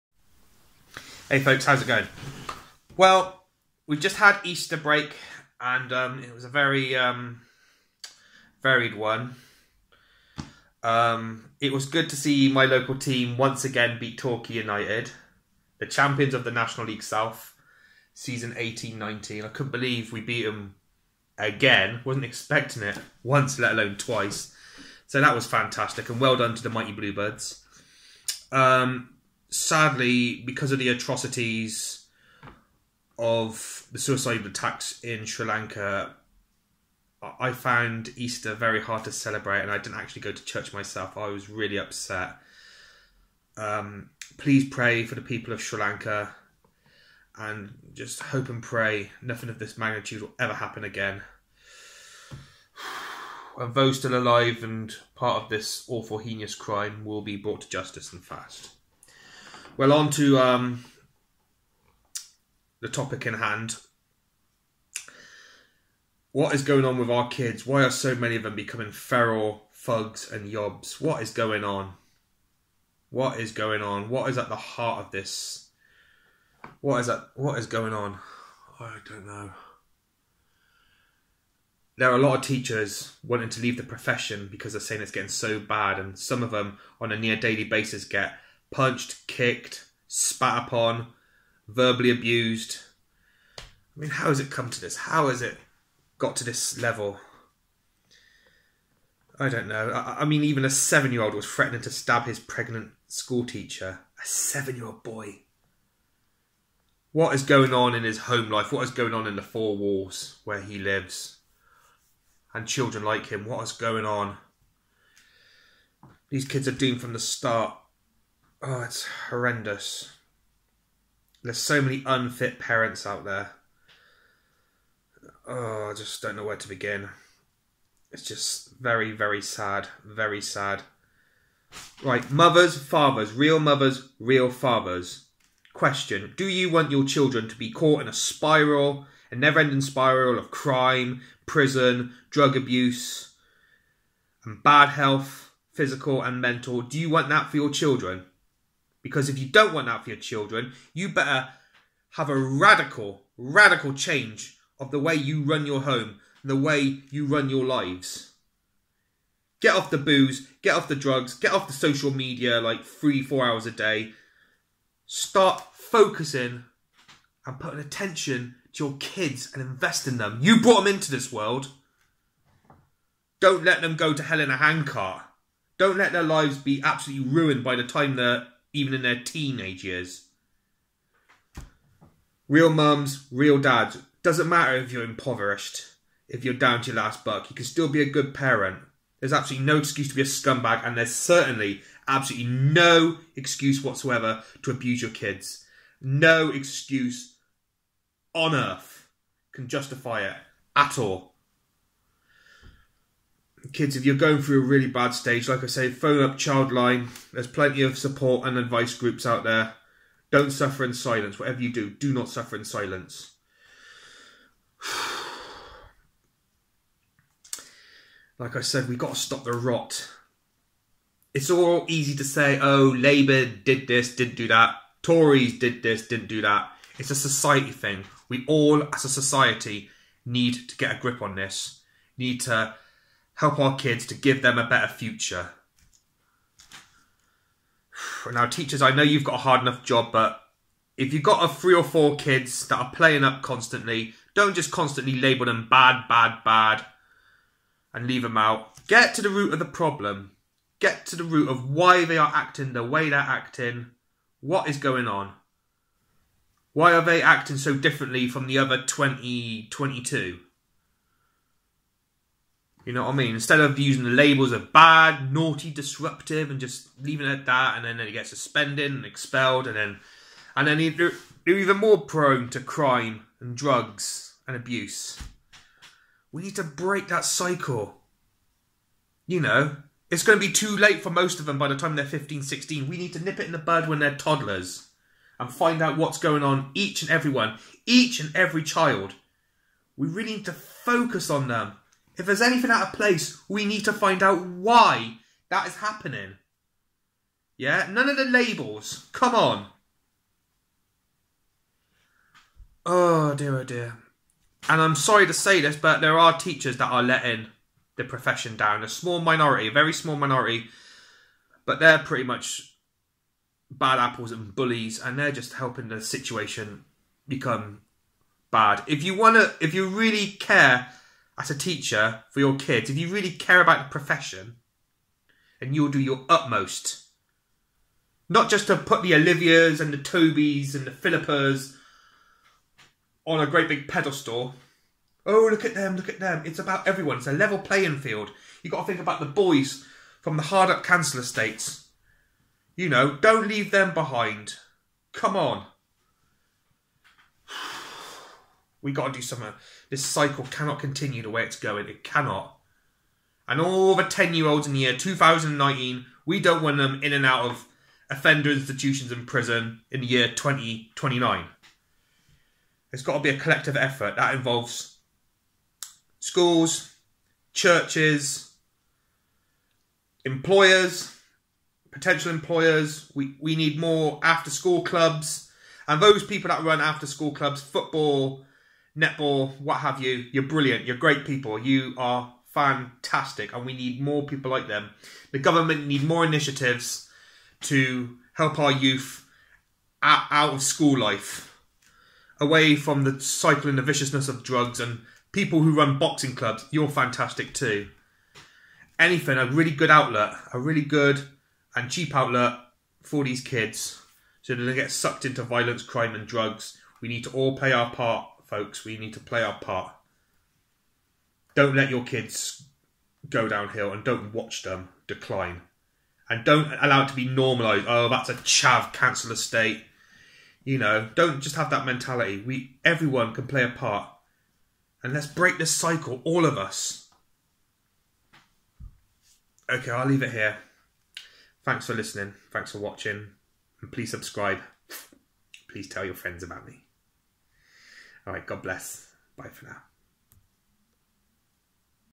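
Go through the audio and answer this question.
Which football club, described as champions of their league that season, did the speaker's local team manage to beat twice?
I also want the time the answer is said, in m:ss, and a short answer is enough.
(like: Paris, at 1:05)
Torquay United, at 0:14.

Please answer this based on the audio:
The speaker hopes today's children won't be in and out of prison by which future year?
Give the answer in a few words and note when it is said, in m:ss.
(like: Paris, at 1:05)
2029, at 6:00.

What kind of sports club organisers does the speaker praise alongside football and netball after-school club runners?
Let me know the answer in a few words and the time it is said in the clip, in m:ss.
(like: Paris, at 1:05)
boxing clubs, at 6:35.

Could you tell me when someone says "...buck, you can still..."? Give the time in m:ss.
3:07.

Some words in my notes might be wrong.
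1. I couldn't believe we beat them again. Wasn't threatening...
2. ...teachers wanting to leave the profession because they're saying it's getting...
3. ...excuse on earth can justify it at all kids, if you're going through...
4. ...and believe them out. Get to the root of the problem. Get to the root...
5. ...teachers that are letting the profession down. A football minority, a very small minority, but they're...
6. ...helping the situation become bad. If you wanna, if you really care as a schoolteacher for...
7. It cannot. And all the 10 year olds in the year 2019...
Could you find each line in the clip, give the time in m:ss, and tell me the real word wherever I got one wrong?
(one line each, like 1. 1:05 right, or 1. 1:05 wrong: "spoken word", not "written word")
1. 0:19 wrong: "expecting", not "threatening"
2. 1:22 right
3. 3:16 right
4. 4:07 wrong: "leave", not "believe"
5. 5:06 wrong: "small", not "football"
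6. 5:15 wrong: "teacher", not "schoolteacher"
7. 5:51 right.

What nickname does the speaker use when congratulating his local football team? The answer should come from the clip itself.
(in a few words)
the Mighty Bluebirds.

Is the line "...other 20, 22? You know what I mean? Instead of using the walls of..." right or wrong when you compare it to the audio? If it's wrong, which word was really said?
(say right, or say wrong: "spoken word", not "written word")
wrong: "labels", not "walls".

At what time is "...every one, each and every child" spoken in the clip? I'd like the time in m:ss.
4:47.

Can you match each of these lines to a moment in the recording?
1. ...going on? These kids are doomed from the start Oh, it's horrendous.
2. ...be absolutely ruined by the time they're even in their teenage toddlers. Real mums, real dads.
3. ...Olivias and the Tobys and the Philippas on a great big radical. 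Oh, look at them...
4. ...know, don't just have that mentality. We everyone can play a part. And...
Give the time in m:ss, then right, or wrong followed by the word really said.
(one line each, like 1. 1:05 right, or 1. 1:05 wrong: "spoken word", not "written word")
1. 1:53 right
2. 2:56 wrong: "years", not "toddlers"
3. 5:29 wrong: "pedestal", not "radical"
4. 7:00 right.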